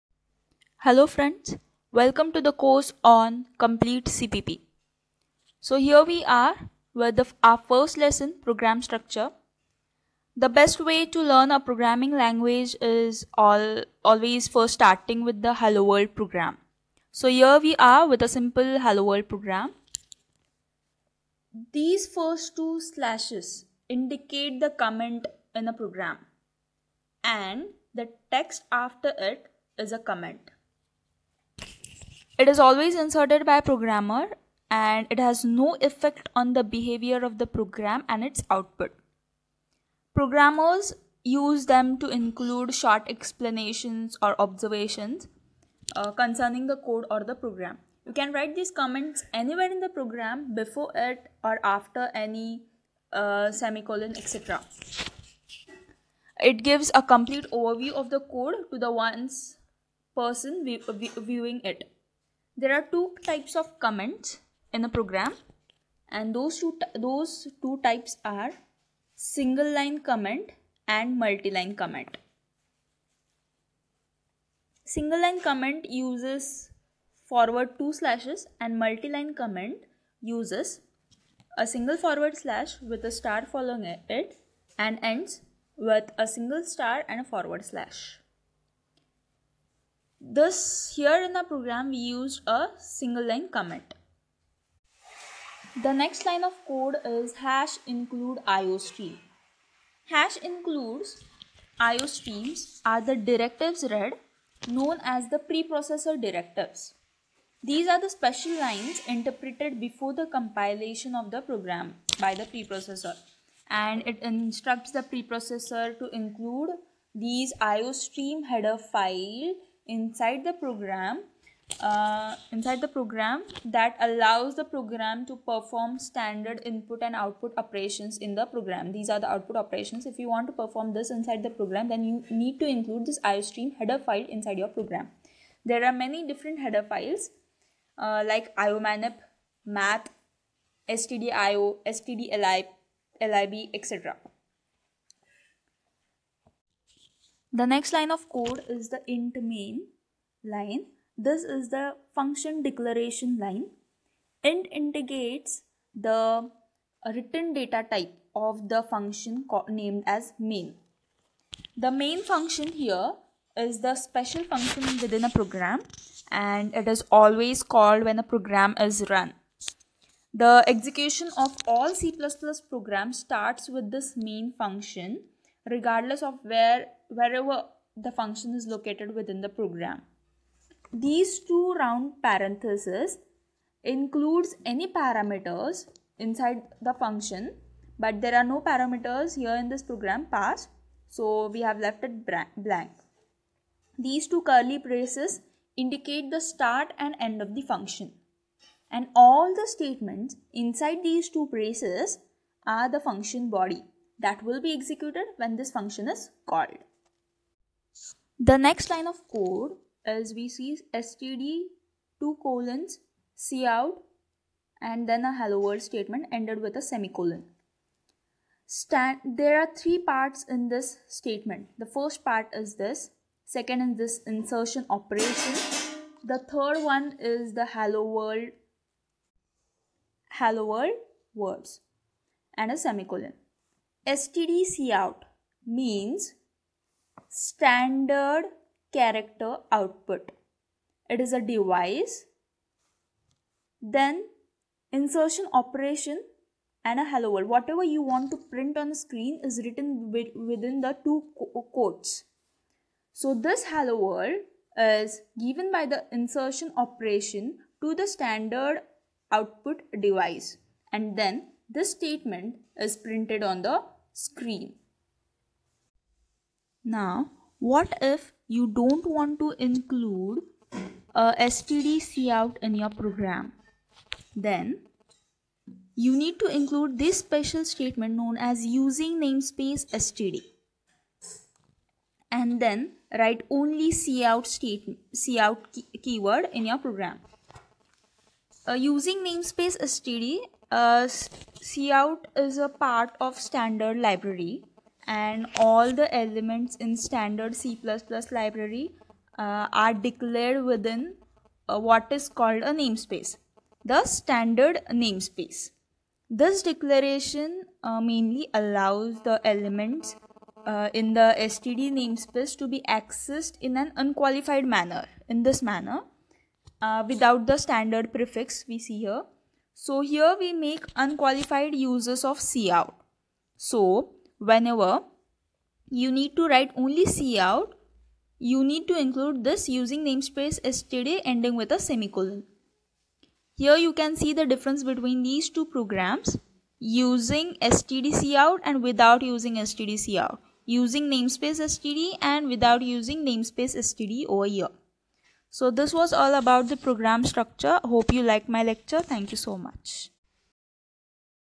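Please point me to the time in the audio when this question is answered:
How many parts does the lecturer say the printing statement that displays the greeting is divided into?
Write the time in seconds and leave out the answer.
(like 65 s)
219 s.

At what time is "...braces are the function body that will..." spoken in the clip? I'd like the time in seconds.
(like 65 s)
201 s.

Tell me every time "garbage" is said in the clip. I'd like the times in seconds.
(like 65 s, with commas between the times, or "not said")
not said.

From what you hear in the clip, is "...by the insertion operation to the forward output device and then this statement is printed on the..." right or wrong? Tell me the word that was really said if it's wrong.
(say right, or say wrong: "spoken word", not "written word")
wrong: "standard", not "forward".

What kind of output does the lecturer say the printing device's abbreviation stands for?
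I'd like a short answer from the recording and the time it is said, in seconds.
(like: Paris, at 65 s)
standard character output, at 237 s.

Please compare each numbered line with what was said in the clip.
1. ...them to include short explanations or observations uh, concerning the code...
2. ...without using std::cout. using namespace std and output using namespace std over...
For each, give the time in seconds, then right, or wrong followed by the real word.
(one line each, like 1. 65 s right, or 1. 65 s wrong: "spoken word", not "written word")
1. 41 s right
2. 338 s wrong: "without", not "output".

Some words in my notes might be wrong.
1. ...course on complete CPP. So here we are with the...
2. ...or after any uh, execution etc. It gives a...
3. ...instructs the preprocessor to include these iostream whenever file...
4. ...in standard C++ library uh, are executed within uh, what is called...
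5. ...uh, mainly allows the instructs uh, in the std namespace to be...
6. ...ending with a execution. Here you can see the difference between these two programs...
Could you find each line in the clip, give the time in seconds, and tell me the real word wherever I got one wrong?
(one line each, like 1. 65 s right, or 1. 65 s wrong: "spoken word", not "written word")
1. 2 s right
2. 51 s wrong: "semicolon", not "execution"
3. 114 s wrong: "header", not "whenever"
4. 296 s wrong: "declared", not "executed"
5. 307 s wrong: "elements", not "instructs"
6. 331 s wrong: "semicolon", not "execution".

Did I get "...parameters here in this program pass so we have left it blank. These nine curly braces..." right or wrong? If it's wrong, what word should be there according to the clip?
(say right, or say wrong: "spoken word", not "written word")
wrong: "two", not "nine".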